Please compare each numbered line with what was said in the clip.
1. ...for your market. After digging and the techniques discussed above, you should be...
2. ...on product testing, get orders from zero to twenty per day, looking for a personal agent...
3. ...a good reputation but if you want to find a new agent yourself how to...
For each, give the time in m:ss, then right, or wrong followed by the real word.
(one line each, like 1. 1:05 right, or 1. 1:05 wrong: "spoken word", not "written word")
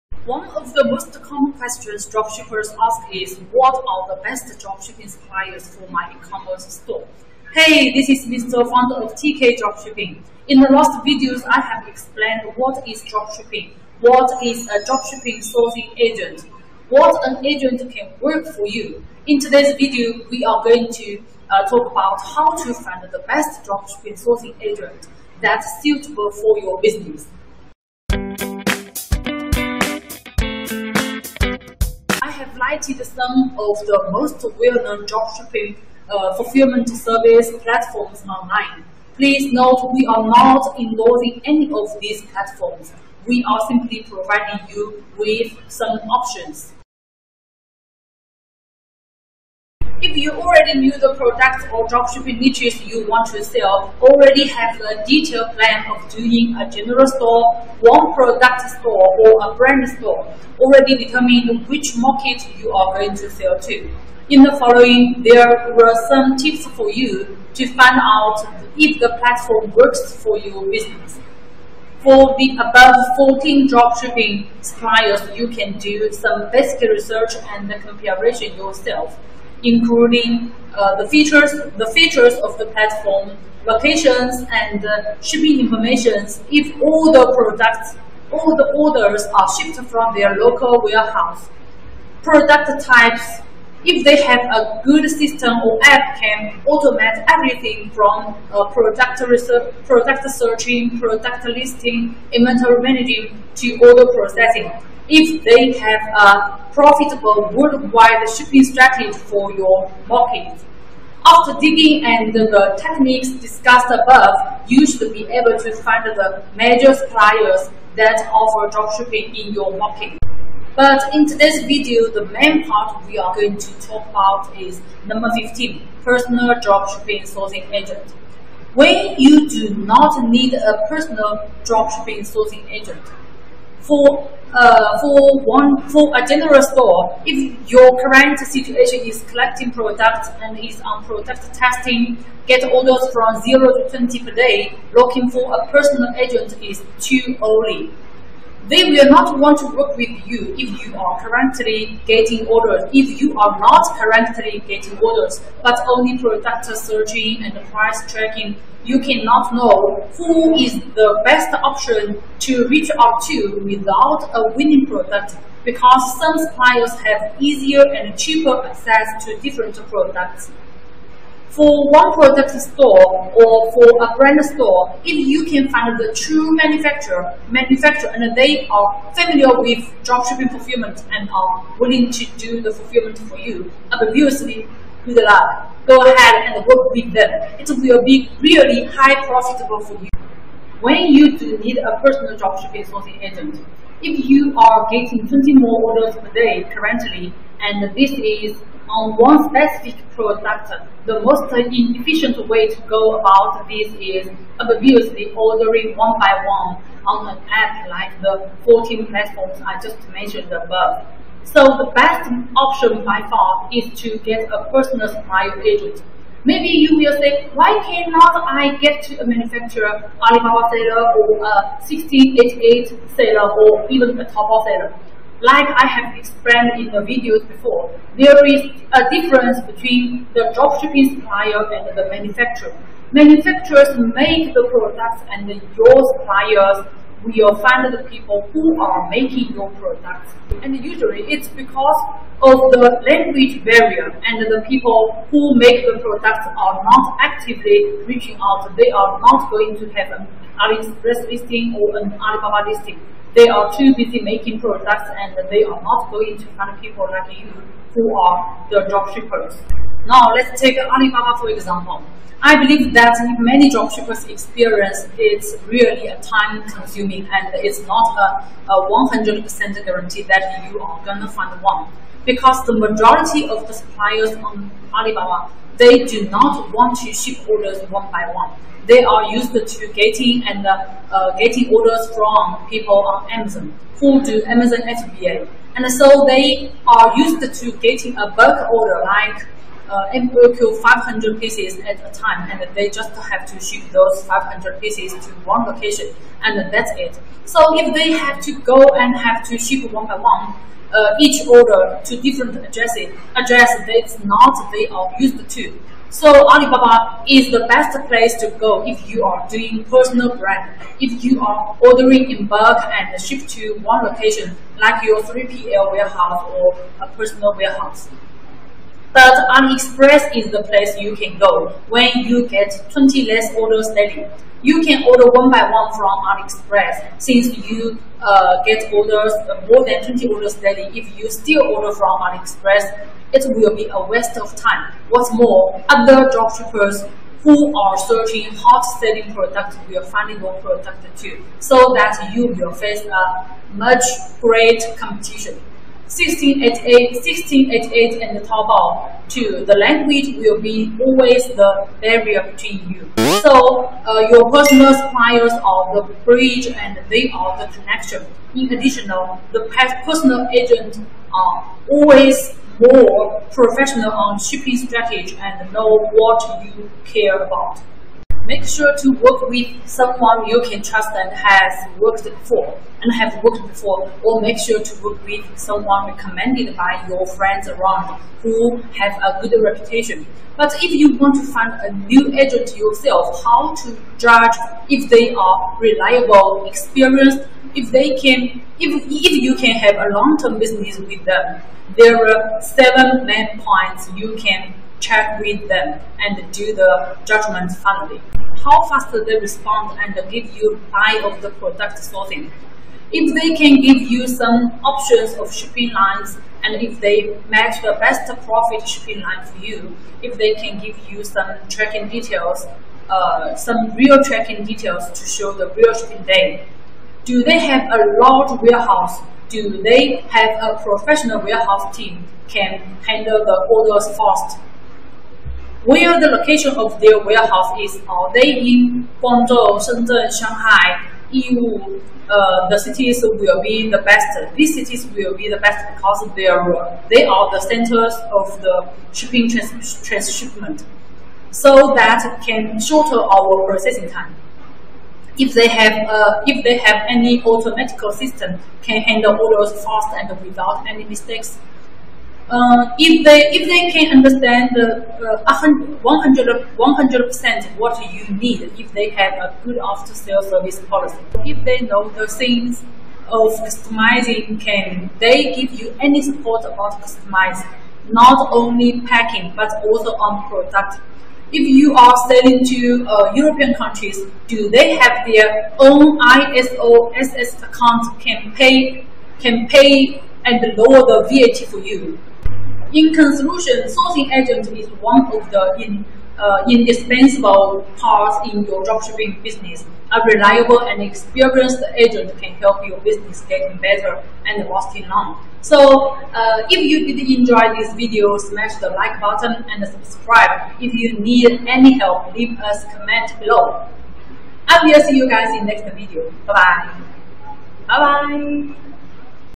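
1. 1:49 right
2. 2:20 right
3. 6:19 right.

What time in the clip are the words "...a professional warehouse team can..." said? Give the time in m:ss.
7:00.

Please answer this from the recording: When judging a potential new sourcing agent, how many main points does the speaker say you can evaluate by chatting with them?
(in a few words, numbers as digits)
7.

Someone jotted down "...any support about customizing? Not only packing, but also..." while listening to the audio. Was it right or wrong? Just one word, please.
right.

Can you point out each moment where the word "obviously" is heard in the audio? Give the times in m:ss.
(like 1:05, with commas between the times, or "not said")
3:03, 3:24.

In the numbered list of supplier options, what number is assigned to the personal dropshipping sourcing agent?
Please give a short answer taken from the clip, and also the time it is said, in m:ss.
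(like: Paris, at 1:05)
15, at 2:05.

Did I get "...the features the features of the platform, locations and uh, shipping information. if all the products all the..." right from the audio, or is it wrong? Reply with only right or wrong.
right.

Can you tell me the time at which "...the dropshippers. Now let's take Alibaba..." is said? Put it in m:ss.
4:18.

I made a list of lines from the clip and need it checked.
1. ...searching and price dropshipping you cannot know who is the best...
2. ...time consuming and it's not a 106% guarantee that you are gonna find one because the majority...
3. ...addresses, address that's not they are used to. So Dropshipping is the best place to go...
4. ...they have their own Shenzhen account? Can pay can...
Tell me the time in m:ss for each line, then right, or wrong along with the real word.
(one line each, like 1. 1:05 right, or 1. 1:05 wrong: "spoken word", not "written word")
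1. 2:36 wrong: "tracking", not "dropshipping"
2. 4:26 wrong: "100", not "106"
3. 5:02 wrong: "Alibaba", not "Dropshipping"
4. 7:54 wrong: "IOSS", not "Shenzhen".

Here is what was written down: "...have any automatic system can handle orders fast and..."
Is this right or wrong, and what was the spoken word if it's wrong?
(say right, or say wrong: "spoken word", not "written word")
right.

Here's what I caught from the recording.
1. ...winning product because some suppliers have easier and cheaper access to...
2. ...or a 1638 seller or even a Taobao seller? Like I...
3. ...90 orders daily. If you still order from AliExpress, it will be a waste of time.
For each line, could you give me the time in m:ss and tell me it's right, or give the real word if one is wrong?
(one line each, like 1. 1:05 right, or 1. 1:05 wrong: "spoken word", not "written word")
1. 2:44 right
2. 3:41 wrong: "1688", not "1638"
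3. 5:30 wrong: "20", not "90".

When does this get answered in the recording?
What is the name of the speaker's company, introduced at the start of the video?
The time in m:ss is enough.
0:09.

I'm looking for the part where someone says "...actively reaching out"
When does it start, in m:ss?
4:07.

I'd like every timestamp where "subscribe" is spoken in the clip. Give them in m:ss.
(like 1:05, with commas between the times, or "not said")
8:19.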